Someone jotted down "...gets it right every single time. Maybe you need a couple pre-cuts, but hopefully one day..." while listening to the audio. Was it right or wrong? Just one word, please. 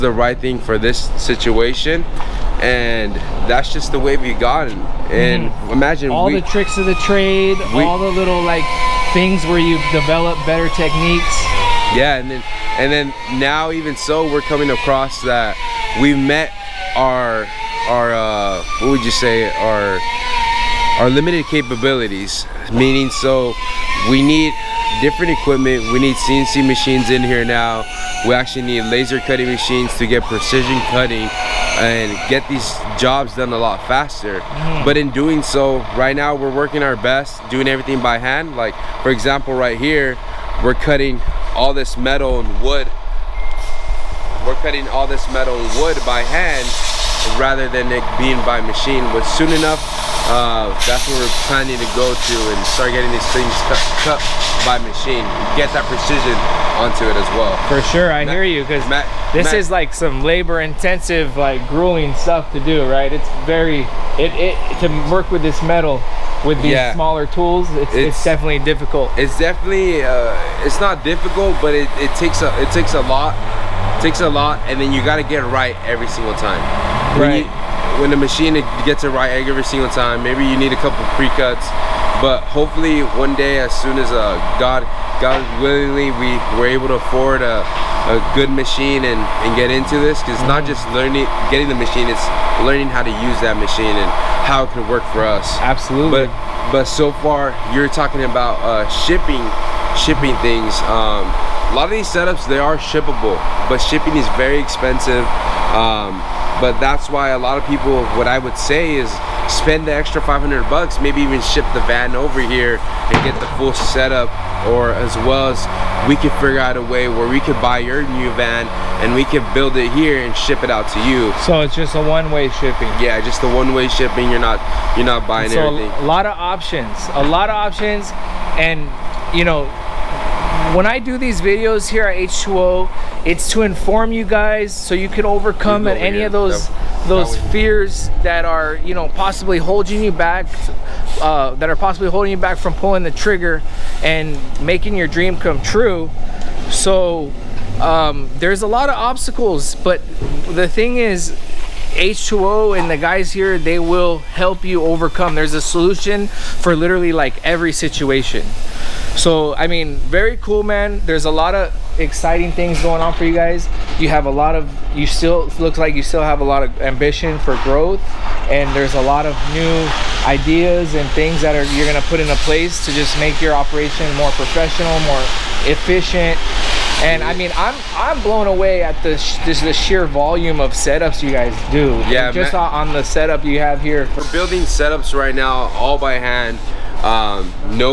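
right.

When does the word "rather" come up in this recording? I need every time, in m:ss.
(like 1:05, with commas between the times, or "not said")
0:47.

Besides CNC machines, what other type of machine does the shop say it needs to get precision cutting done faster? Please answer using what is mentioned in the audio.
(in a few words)
Laser cutting machines.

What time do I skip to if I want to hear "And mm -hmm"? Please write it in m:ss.
0:05.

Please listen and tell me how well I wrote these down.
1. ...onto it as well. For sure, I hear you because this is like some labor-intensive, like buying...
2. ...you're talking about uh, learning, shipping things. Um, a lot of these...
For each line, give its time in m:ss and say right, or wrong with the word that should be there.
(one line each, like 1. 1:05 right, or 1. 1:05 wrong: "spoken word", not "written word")
1. 0:56 wrong: "grueling", not "buying"
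2. 1:37 wrong: "shipping", not "learning".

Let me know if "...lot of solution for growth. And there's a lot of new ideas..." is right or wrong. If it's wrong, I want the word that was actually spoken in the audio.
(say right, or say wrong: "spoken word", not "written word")
wrong: "ambition", not "solution".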